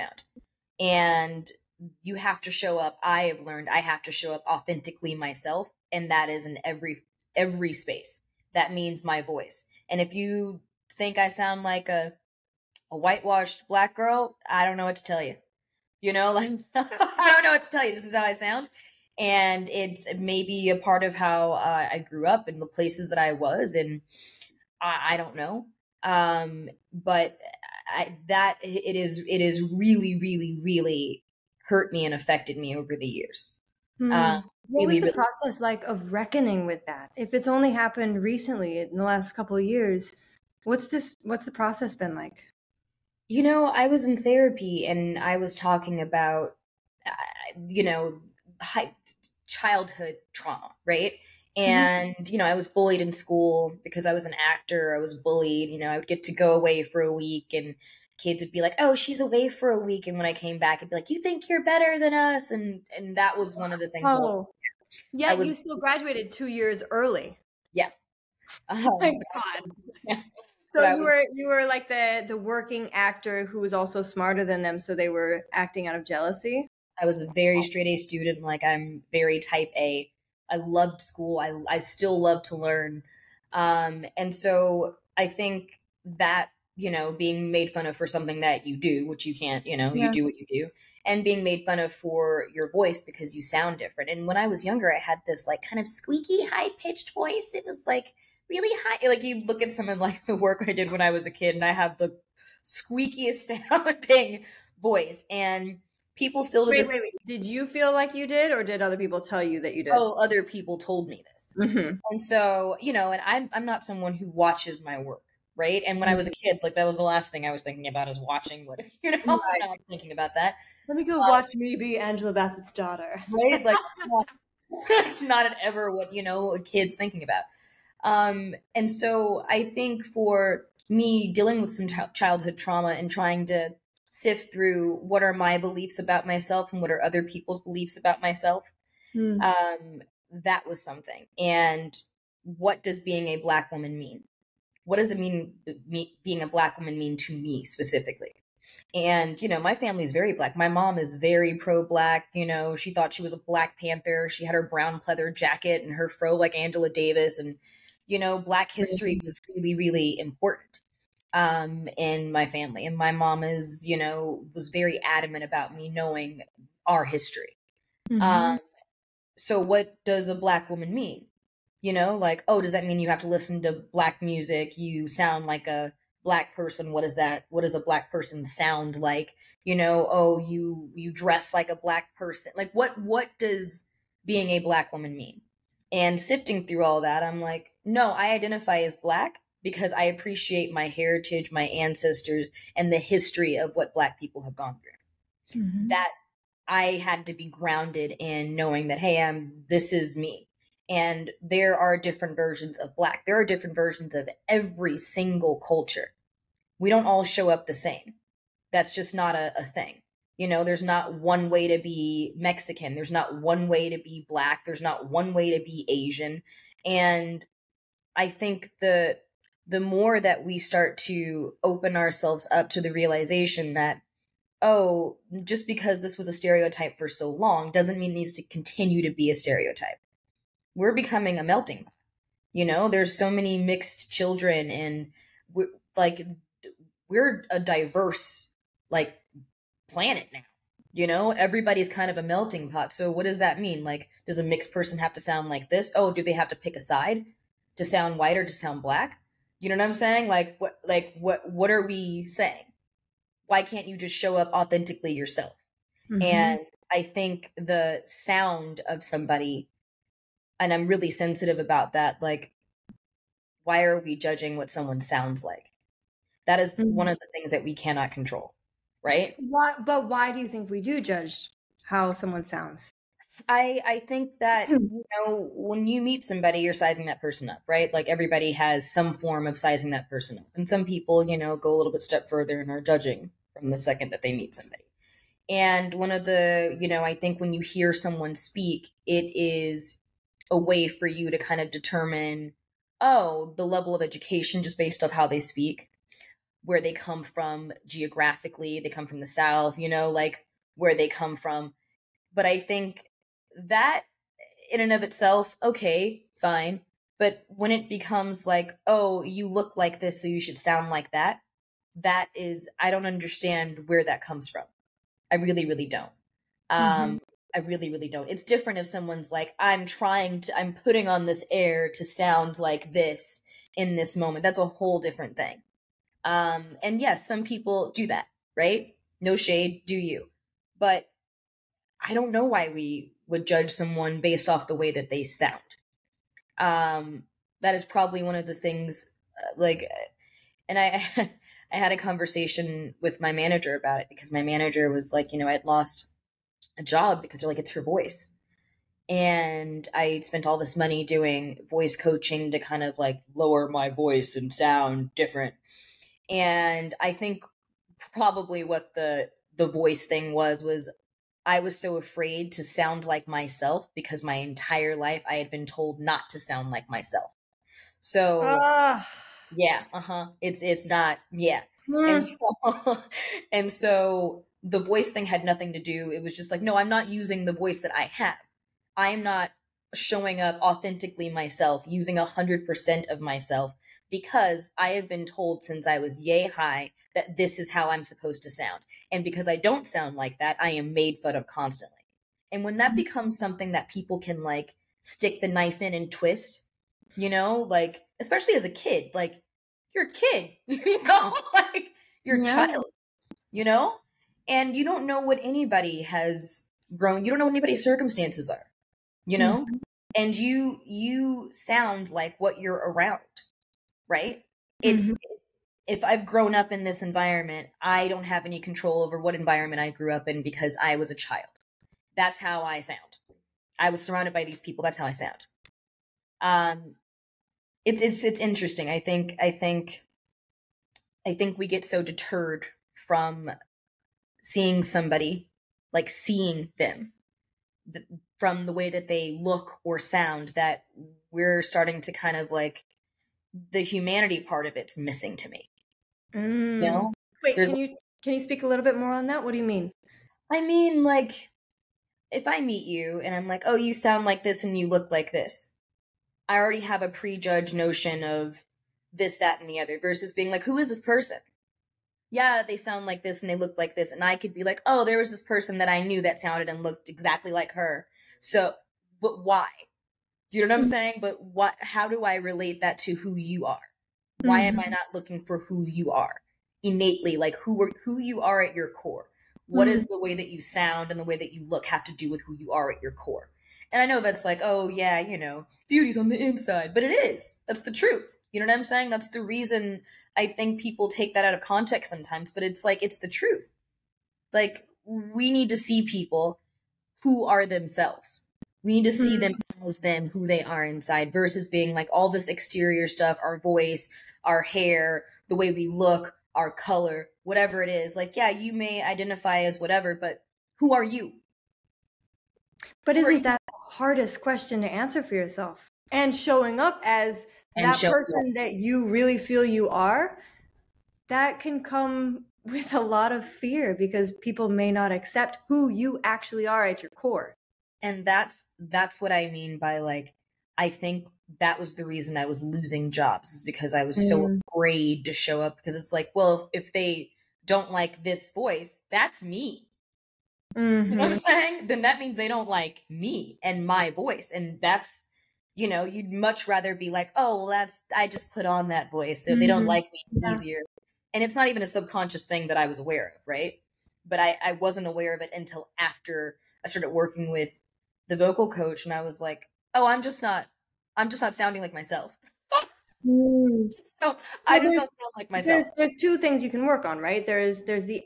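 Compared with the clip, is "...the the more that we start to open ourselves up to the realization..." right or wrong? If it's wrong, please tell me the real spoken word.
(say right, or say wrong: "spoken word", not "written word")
right.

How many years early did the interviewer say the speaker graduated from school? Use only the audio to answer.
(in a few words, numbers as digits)
2.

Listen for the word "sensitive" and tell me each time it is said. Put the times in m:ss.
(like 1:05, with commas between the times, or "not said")
4:21.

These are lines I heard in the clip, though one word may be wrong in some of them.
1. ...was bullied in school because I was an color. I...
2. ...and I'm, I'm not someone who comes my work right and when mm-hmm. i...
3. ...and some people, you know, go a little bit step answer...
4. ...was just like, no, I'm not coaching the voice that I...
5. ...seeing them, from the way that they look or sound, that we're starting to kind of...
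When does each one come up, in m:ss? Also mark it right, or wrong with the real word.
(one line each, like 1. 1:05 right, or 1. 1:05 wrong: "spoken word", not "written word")
1. 0:52 wrong: "actor", not "color"
2. 1:53 wrong: "watches", not "comes"
3. 4:40 wrong: "further", not "answer"
4. 6:16 wrong: "using", not "coaching"
5. 7:16 right.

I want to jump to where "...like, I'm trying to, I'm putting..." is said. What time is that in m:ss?
5:19.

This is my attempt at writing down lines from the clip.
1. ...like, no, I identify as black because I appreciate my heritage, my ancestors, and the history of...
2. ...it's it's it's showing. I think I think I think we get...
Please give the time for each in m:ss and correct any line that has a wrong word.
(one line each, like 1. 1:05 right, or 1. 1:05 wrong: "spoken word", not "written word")
1. 3:07 right
2. 7:07 wrong: "interesting", not "showing".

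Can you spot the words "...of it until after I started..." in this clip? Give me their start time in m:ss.
9:15.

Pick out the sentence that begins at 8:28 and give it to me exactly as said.
Like, yeah, you may identify as whatever, but who are you?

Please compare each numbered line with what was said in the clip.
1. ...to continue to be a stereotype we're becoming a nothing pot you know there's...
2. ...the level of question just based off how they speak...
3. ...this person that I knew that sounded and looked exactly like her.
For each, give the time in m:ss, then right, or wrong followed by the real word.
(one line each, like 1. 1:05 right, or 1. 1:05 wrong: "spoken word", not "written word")
1. 3:48 wrong: "melting", not "nothing"
2. 4:53 wrong: "education", not "question"
3. 7:45 right.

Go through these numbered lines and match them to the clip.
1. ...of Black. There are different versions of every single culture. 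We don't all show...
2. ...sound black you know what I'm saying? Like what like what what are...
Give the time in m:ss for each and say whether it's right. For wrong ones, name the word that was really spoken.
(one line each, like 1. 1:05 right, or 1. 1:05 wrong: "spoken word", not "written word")
1. 3:22 right
2. 4:08 right.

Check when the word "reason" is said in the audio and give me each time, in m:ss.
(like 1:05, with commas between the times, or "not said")
8:09, 8:52.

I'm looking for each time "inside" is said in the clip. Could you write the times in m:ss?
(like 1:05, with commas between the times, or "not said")
8:06, 8:20.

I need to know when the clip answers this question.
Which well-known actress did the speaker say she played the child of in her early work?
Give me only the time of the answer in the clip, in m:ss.
2:01.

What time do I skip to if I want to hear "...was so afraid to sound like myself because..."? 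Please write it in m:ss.
6:01.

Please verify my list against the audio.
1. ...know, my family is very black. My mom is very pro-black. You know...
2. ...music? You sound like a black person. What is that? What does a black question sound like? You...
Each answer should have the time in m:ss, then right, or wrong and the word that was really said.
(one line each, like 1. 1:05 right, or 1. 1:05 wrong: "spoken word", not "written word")
1. 2:29 right
2. 2:54 wrong: "person", not "question".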